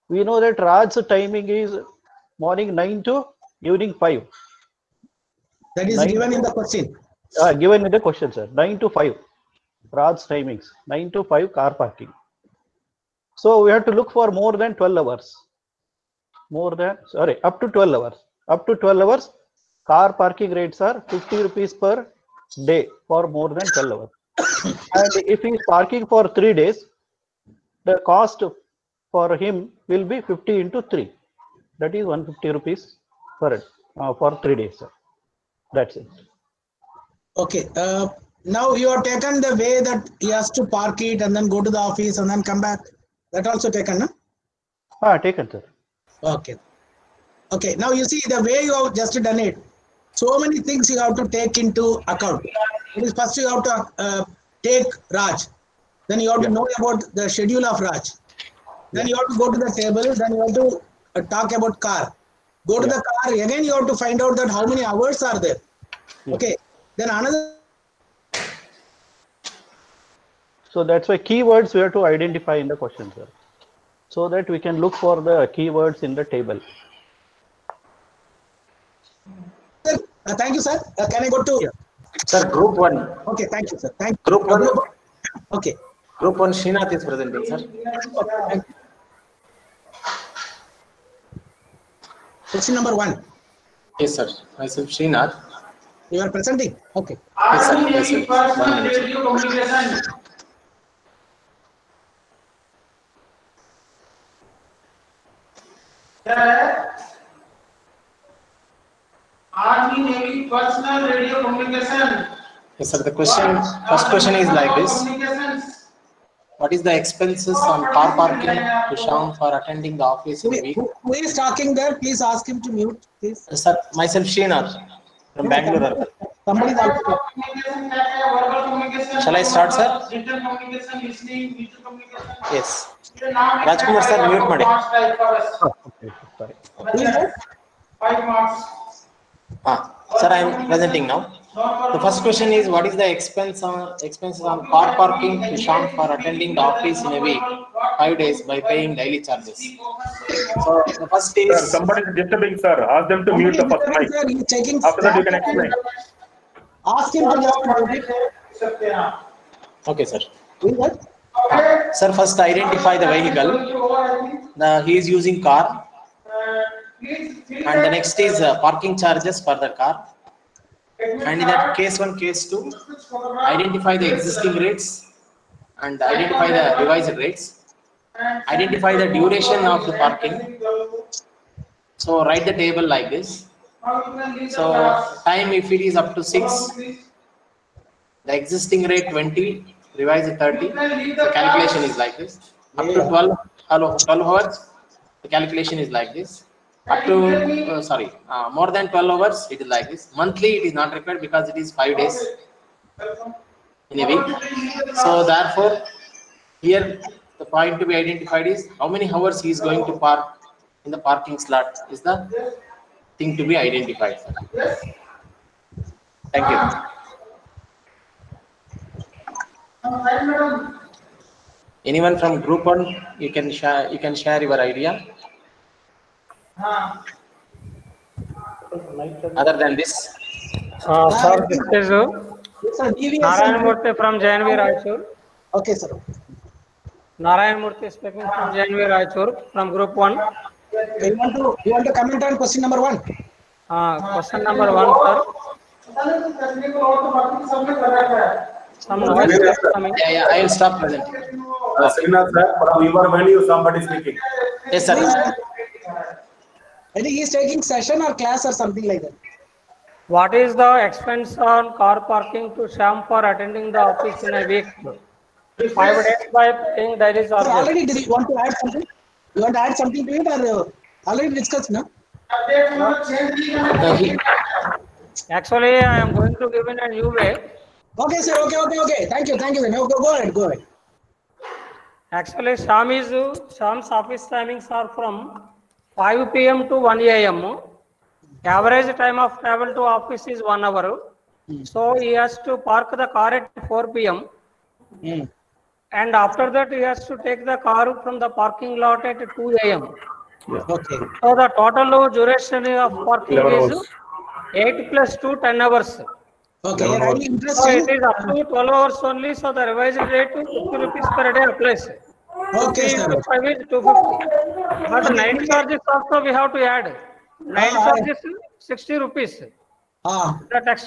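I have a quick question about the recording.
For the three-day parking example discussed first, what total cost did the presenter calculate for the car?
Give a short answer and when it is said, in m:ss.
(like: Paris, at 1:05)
150 rupees, at 0:32.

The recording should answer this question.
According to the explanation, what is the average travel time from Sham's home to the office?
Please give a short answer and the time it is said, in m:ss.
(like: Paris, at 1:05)
1 hour, at 4:50.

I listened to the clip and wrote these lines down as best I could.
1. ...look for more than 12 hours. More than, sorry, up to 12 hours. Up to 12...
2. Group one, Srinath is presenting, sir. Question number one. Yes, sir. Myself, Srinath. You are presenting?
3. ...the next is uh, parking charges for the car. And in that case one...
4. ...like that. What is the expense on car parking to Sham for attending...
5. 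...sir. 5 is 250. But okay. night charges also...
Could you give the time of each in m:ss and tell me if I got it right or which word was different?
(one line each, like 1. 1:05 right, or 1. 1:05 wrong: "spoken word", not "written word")
1. 0:13 right
2. 1:26 right
3. 2:47 right
4. 4:18 right
5. 5:12 right.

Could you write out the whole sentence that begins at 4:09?
Yeah, yeah, I will stop presenting.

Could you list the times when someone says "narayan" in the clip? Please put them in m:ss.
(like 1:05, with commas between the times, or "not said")
3:53, 3:57.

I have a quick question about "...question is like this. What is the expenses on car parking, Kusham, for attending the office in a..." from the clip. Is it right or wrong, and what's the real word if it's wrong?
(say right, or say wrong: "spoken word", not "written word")
right.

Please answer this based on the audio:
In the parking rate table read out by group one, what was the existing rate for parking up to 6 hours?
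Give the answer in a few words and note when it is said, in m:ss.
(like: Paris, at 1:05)
20, at 3:06.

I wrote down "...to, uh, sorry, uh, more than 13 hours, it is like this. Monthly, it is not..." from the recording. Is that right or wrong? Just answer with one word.
wrong.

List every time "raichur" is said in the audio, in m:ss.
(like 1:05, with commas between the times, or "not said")
3:54, 3:58.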